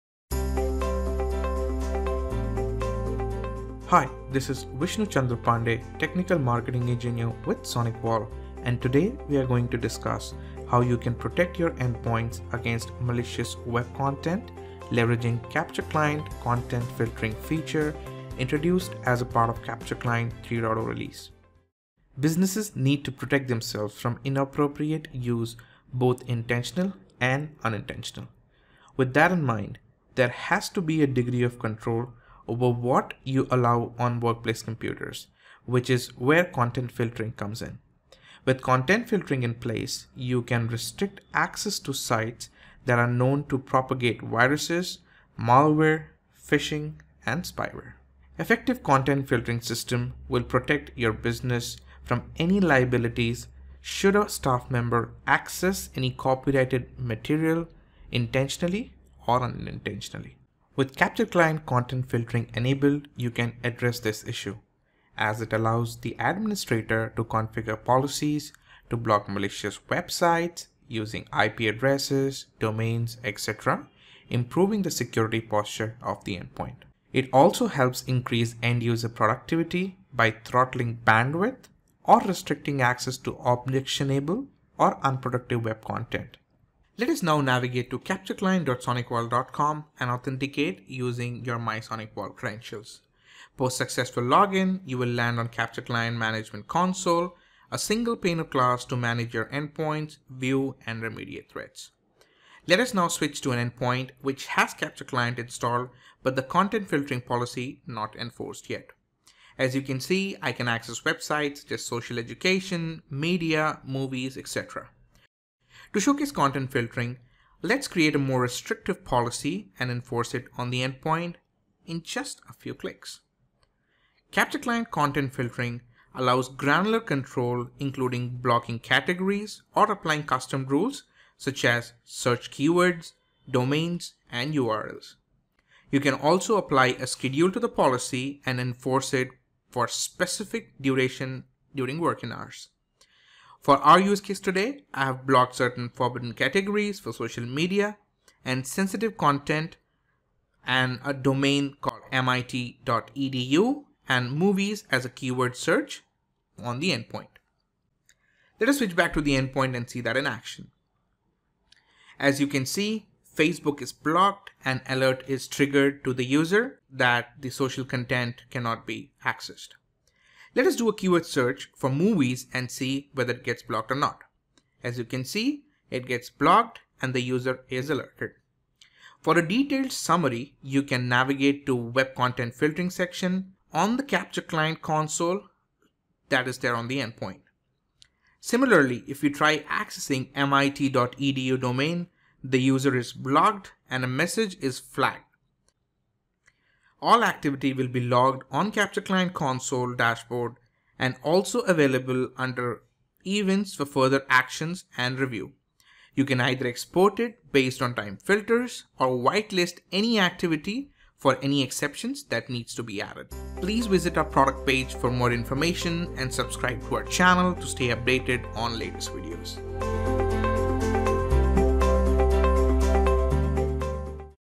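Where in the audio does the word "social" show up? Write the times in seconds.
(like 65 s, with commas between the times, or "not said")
111 s, 147 s, 167 s.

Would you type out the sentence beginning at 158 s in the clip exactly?
Let us switch back to the endpoint and see that in action.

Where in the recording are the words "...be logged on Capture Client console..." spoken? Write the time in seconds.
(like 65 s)
197 s.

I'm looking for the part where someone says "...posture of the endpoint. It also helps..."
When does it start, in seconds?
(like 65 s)
75 s.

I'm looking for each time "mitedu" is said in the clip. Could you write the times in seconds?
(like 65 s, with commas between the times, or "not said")
152 s, 190 s.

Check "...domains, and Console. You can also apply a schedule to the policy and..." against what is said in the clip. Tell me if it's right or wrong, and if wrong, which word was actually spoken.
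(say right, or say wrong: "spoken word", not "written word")
wrong: "URLs", not "Console".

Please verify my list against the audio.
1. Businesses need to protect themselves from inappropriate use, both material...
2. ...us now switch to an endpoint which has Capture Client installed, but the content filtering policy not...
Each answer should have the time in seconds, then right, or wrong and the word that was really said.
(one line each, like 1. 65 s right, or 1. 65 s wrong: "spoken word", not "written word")
1. 22 s wrong: "intentional", not "material"
2. 102 s right.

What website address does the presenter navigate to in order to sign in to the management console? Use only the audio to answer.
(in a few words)
captureclient.sonicwall.com.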